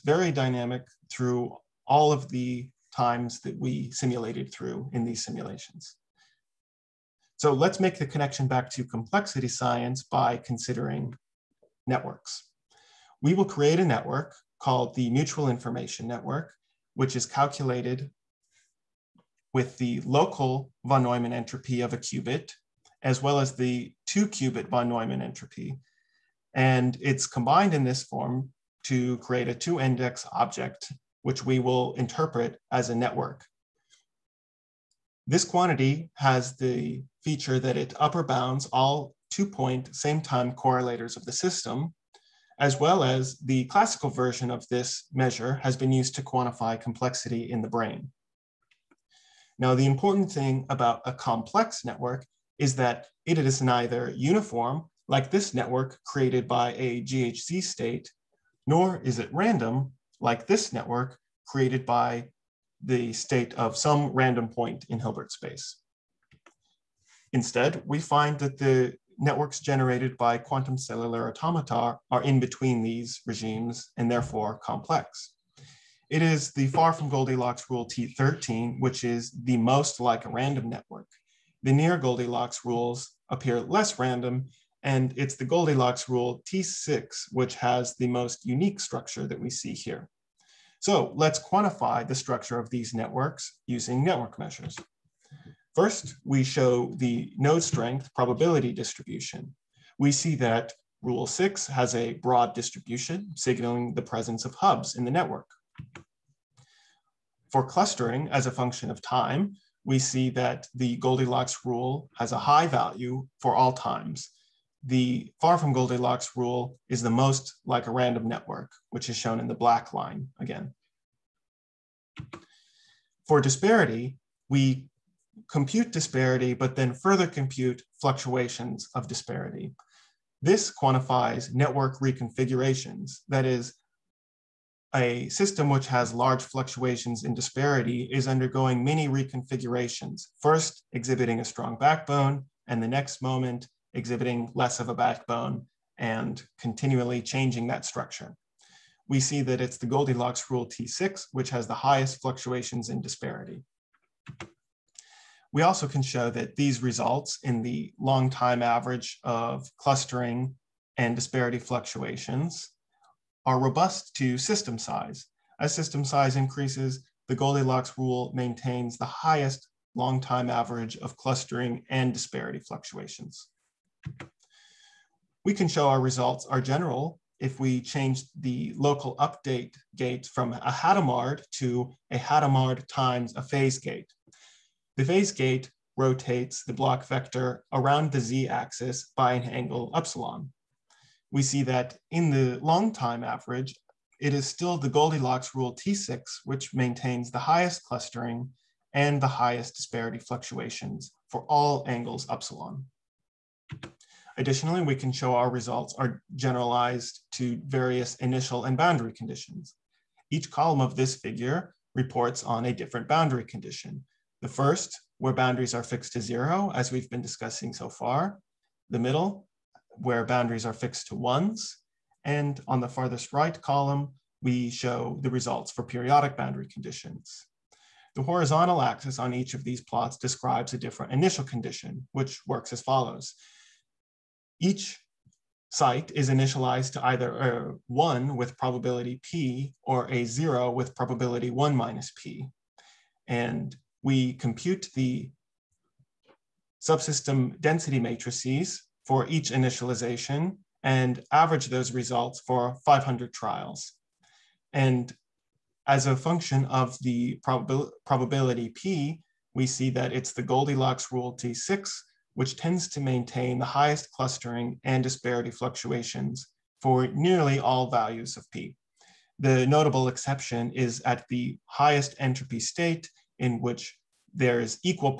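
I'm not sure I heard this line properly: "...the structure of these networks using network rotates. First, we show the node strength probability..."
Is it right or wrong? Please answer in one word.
wrong.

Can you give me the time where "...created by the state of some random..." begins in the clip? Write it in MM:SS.
01:01.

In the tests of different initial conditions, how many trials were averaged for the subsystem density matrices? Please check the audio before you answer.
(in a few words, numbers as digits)
500.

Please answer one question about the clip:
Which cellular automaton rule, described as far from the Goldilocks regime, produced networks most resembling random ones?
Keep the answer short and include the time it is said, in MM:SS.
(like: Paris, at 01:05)
T13, at 01:17.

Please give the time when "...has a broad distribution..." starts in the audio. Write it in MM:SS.
01:41.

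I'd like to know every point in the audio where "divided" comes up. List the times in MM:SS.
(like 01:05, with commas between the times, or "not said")
not said.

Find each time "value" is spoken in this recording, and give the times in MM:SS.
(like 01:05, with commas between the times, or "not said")
01:52, 04:27.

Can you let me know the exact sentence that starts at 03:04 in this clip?
The phase gate rotates the Bloch vector around the z-axis by an angle epsilon.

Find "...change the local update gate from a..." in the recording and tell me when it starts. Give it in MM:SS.
02:57.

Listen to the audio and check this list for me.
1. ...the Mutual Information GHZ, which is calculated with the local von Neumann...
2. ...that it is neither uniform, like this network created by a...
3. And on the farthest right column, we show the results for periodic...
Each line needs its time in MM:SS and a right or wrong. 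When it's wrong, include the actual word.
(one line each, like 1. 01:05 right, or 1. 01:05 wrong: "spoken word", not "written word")
1. 00:14 wrong: "Network", not "GHZ"
2. 00:52 right
3. 03:42 right.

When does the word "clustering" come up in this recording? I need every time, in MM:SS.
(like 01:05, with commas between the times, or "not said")
01:47, 02:39, 02:51, 03:17, 04:24.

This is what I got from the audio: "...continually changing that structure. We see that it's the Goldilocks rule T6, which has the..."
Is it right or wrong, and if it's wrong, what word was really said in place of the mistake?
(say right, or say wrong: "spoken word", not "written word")
right.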